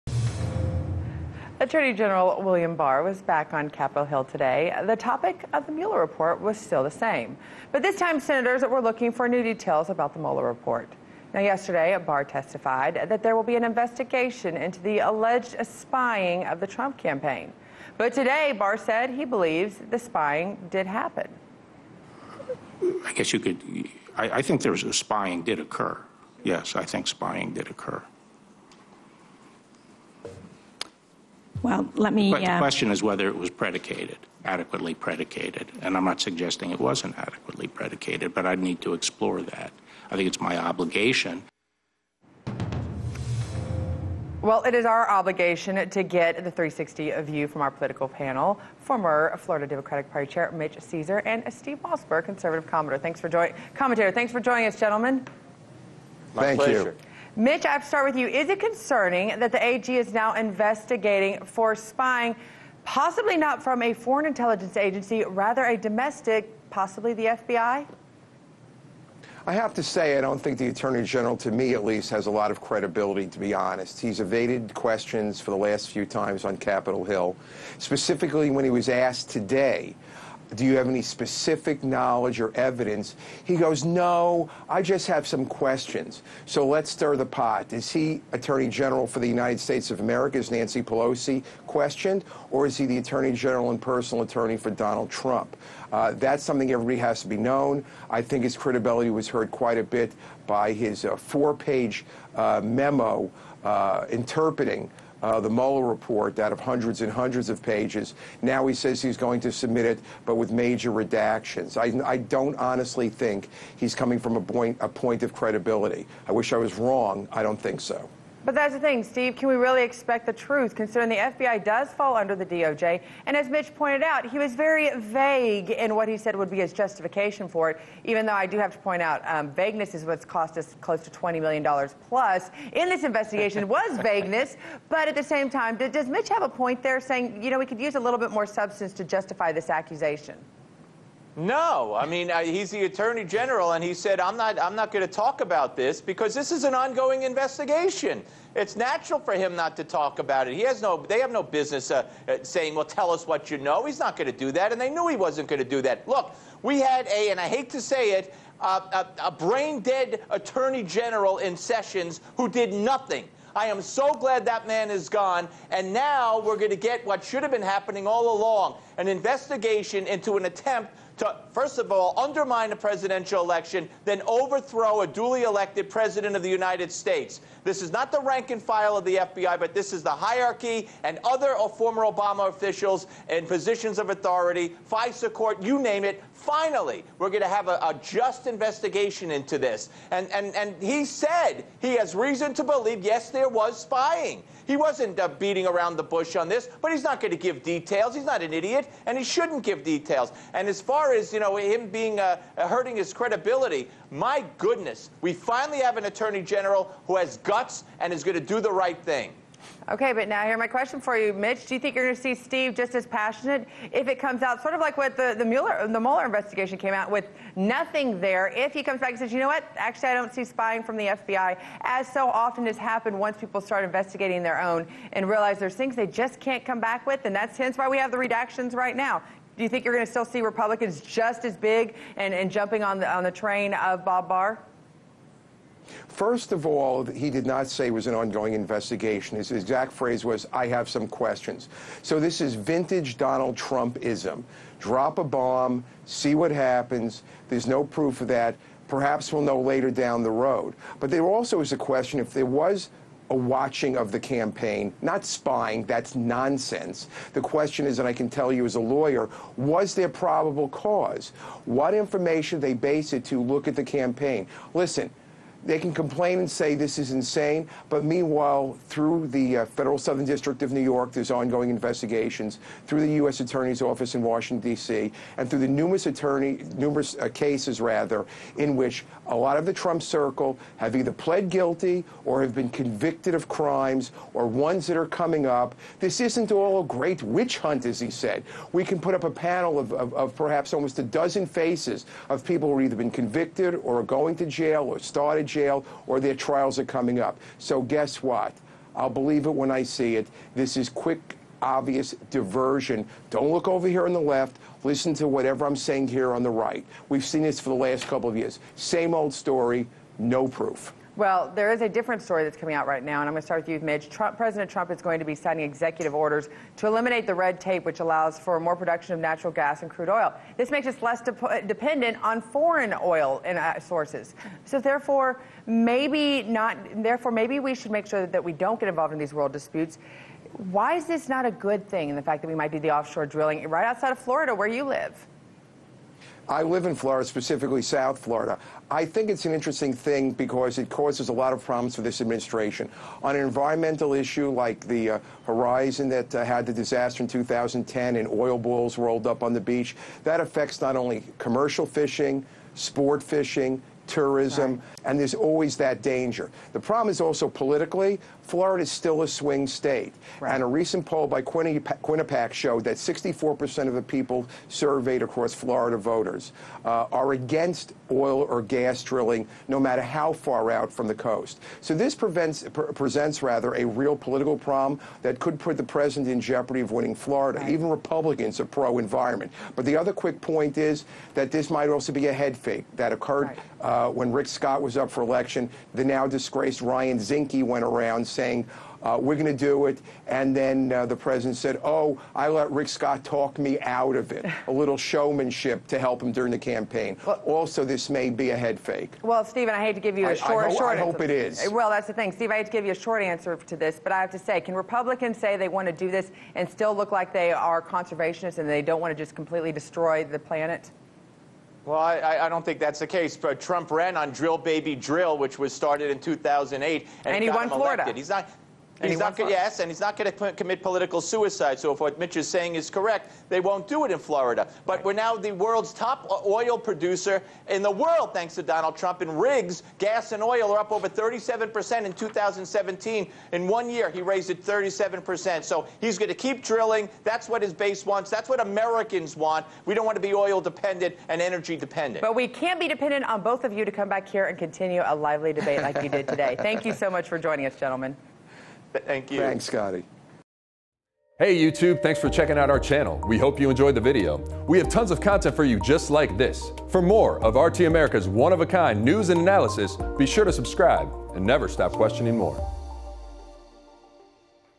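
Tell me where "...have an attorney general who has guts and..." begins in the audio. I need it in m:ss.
3:25.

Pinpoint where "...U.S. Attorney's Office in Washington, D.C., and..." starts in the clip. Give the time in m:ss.
4:33.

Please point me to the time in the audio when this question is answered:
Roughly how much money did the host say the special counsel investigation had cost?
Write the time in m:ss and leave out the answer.
2:11.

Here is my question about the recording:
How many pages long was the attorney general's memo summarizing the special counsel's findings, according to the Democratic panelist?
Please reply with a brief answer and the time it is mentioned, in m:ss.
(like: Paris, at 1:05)
4, at 1:41.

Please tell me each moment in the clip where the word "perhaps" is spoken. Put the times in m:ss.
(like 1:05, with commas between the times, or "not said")
4:08, 4:50.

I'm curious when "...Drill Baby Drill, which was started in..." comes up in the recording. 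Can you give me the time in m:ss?
6:54.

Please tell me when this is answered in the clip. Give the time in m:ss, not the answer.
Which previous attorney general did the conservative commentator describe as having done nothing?
2:41.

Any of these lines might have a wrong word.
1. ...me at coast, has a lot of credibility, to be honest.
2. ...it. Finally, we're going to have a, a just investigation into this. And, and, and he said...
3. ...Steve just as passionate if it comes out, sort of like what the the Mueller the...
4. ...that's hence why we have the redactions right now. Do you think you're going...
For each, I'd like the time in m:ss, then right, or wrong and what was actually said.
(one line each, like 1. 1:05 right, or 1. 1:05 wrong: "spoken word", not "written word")
1. 1:11 wrong: "least", not "coast"
2. 3:06 right
3. 3:32 right
4. 3:47 right.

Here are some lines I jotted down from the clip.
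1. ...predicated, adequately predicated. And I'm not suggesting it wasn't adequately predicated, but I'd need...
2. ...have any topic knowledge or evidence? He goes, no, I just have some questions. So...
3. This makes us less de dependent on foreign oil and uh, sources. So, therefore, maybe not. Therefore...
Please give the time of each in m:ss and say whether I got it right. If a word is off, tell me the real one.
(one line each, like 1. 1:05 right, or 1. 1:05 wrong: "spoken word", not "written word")
1. 0:33 right
2. 1:20 wrong: "specific", not "topic"
3. 5:20 right.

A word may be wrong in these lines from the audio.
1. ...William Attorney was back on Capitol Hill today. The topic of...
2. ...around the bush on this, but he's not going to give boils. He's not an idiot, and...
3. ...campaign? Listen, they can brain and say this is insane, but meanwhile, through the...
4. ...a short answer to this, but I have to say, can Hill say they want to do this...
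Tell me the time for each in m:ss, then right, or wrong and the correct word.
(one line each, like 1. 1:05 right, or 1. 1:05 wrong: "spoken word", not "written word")
1. 0:02 wrong: "Barr", not "Attorney"
2. 3:15 wrong: "details", not "boils"
3. 4:23 wrong: "complain", not "brain"
4. 6:42 wrong: "Republicans", not "Hill".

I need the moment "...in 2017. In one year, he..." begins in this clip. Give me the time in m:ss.
7:12.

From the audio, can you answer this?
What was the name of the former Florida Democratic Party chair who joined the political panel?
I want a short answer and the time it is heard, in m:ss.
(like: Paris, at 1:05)
Mitch Ceasar, at 0:50.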